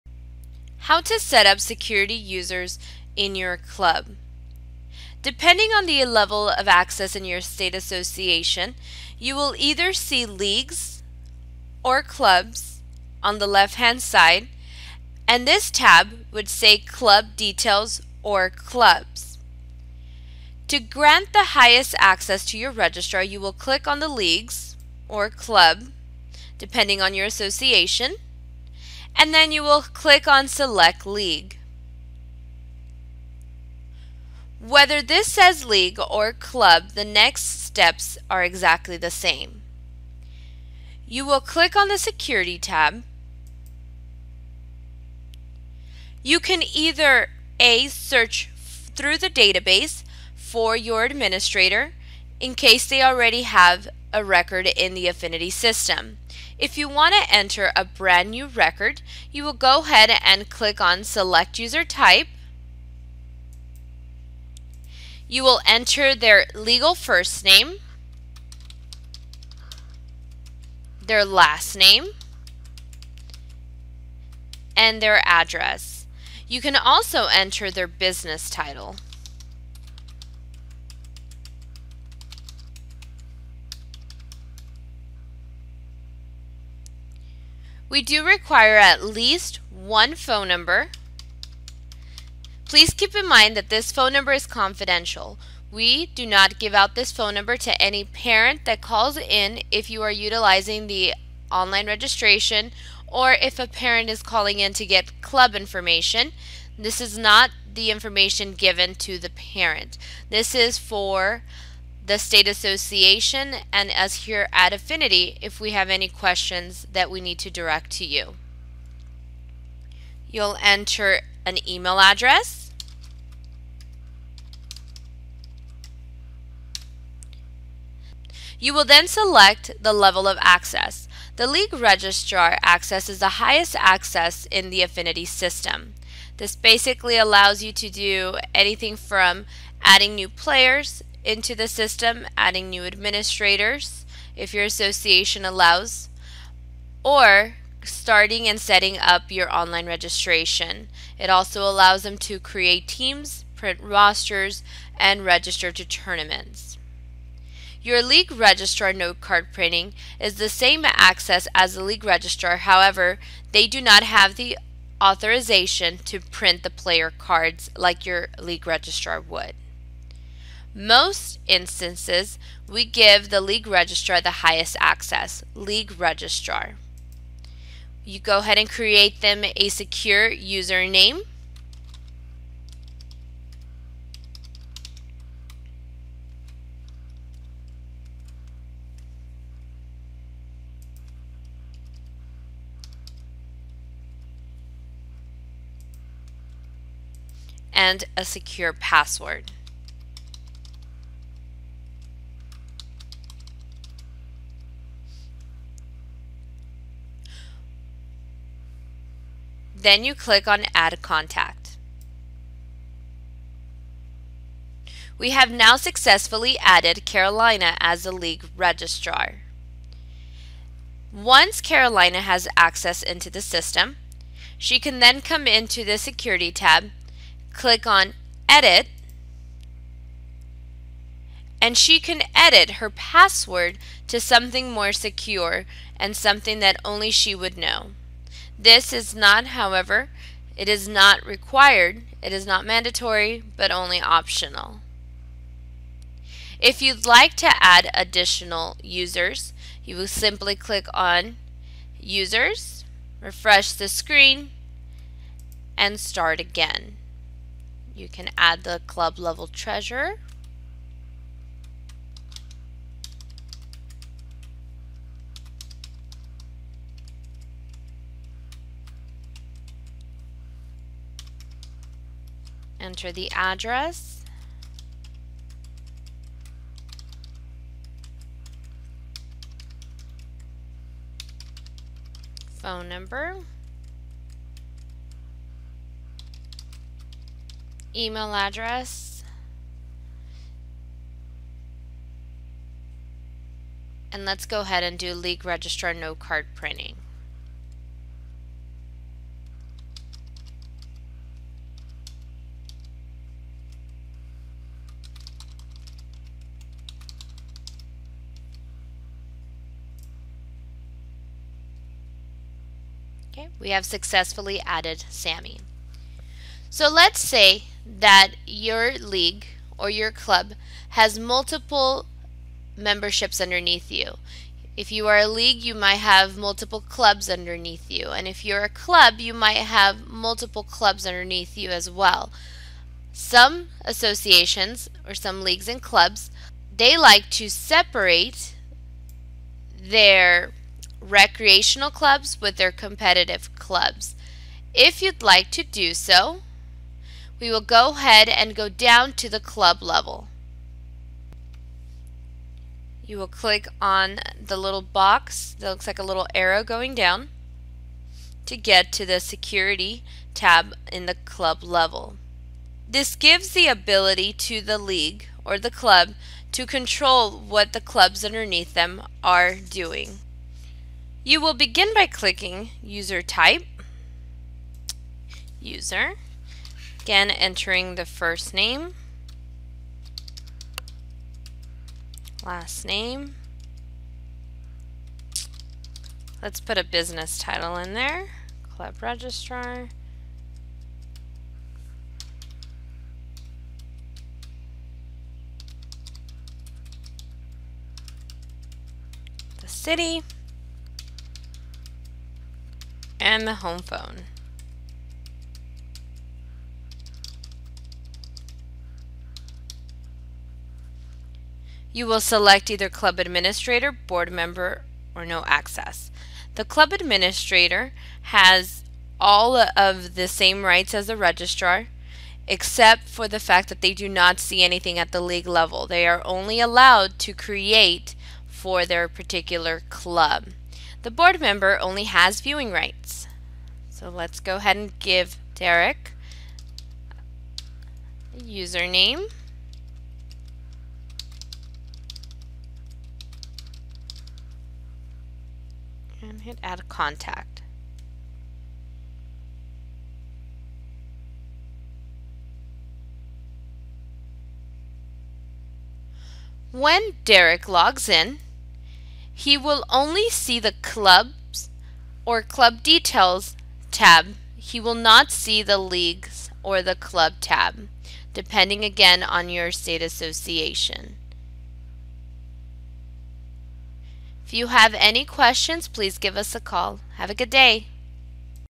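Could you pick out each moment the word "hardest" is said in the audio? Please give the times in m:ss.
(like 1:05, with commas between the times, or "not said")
not said.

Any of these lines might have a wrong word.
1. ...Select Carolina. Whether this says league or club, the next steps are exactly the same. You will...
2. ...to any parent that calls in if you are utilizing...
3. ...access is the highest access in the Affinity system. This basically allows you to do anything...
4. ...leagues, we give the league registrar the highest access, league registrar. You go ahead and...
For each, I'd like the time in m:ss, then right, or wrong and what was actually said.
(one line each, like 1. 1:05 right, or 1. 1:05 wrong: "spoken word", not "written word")
1. 0:30 wrong: "League", not "Carolina"
2. 1:37 right
3. 2:12 right
4. 2:51 wrong: "instances", not "leagues".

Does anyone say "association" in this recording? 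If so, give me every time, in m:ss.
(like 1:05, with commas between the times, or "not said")
0:07, 0:27, 1:52, 2:24, 5:33, 7:50.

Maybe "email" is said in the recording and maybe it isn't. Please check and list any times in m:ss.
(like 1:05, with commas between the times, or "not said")
2:01, 4:47.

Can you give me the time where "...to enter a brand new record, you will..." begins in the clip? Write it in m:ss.
0:57.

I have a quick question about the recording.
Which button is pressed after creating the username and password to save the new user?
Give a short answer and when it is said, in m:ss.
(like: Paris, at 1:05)
Add Contact, at 3:30.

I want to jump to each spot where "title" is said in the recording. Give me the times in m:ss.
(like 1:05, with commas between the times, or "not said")
1:18, 6:27.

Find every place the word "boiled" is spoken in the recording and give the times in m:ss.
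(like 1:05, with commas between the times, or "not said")
not said.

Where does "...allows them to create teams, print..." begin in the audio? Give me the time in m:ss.
2:31.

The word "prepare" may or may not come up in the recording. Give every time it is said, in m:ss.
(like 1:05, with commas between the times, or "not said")
not said.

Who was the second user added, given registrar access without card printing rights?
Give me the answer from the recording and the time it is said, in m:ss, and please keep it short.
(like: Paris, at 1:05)
Sammy, at 5:15.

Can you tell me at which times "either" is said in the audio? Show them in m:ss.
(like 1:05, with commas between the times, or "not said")
0:09, 0:46, 6:52.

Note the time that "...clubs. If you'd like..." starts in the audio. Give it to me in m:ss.
5:43.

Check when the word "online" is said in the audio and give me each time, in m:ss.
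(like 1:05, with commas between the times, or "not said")
1:41, 2:29.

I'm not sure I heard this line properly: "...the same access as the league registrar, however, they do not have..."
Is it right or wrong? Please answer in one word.
right.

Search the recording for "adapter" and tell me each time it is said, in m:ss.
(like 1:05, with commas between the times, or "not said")
not said.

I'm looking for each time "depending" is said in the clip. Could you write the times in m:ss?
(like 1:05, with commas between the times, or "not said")
0:05, 0:26, 7:48.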